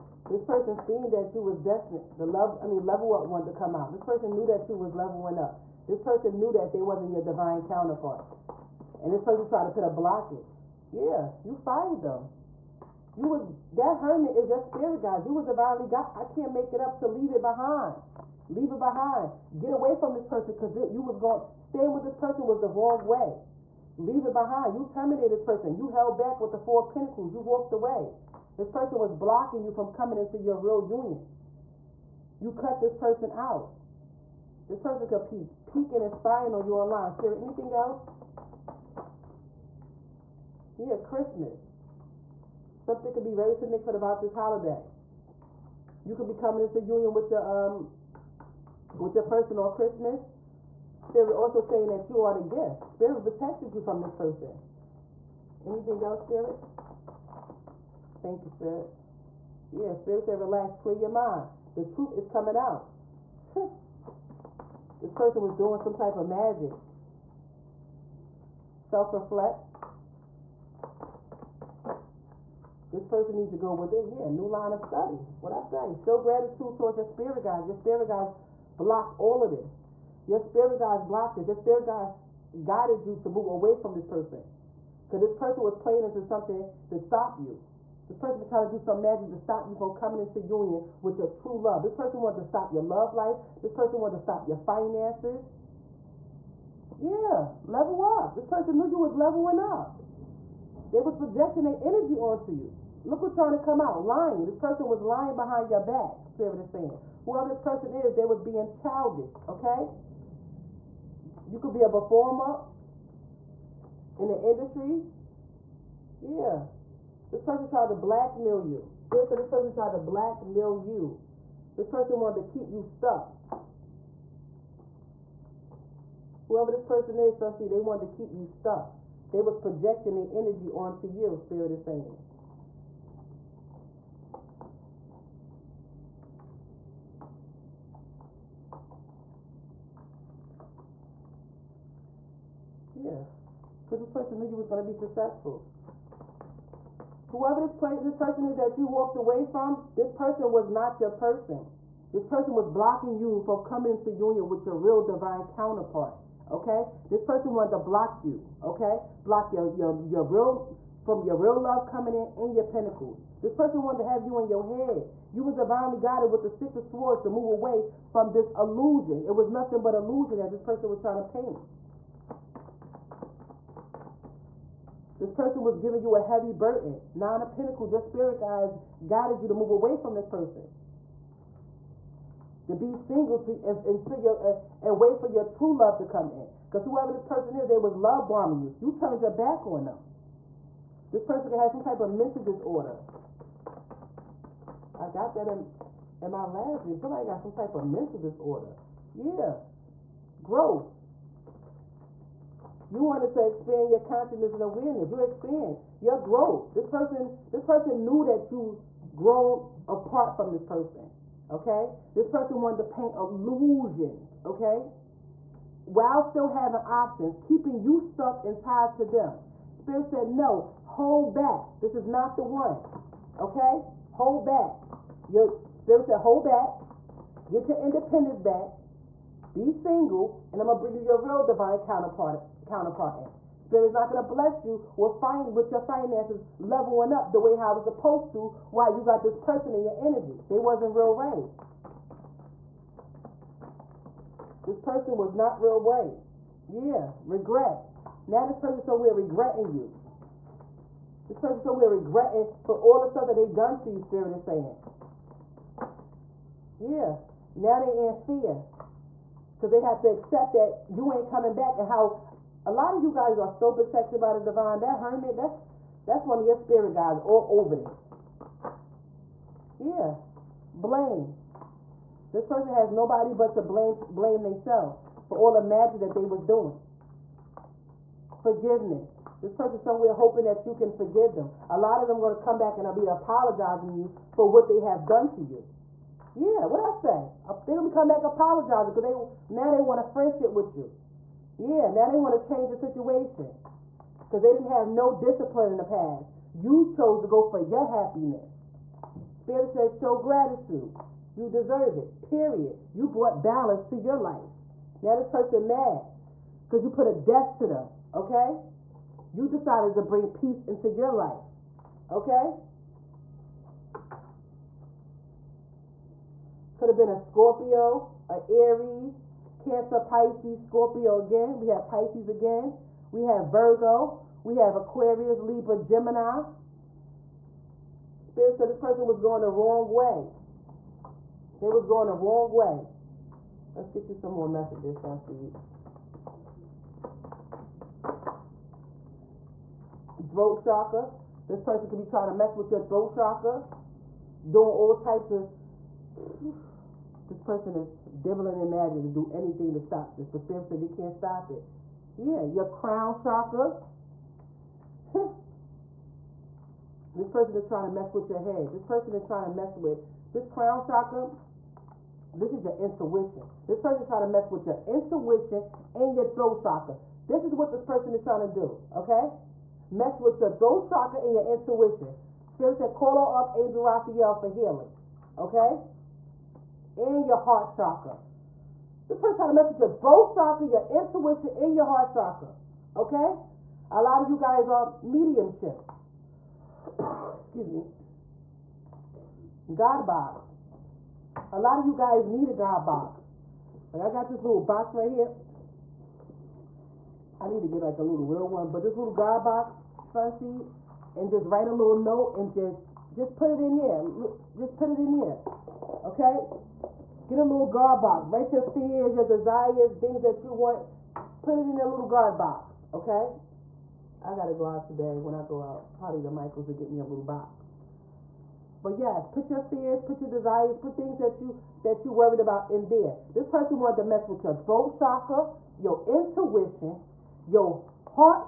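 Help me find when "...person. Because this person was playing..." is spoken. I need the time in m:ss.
1:24.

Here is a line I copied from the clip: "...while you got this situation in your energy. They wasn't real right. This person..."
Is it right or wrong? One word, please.
wrong.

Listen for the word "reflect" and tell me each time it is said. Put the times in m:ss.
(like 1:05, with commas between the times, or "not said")
1:08.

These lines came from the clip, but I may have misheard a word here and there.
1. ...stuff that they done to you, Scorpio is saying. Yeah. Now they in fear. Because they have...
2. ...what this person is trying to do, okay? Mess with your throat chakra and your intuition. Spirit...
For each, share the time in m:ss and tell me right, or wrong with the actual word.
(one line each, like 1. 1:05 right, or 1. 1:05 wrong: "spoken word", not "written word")
1. 4:13 wrong: "Spirit", not "Scorpio"
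2. 6:07 right.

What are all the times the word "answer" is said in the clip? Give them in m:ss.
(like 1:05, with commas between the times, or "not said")
not said.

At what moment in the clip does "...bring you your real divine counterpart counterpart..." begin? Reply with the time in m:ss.
3:50.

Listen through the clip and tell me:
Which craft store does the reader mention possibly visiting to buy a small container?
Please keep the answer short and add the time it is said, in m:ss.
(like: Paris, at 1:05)
Michaels, at 6:56.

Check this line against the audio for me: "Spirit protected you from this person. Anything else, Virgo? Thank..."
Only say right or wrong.
wrong.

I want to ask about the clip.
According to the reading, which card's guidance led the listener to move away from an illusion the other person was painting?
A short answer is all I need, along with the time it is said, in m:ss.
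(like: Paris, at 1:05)
Six of Swords, at 2:46.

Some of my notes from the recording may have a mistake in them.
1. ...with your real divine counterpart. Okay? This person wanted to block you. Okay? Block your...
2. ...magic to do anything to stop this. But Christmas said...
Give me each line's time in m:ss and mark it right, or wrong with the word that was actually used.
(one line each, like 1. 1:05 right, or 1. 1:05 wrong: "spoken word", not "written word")
1. 2:34 right
2. 5:48 wrong: "Spirit", not "Christmas".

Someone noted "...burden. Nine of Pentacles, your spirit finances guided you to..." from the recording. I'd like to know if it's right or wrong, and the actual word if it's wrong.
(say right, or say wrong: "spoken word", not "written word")
wrong: "guides", not "finances".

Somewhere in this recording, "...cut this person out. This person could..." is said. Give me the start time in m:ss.
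0:32.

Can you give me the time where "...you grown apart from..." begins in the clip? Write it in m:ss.
3:28.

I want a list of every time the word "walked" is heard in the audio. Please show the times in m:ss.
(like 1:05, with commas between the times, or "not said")
0:27, 2:28.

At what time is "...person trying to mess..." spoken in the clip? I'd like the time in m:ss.
6:19.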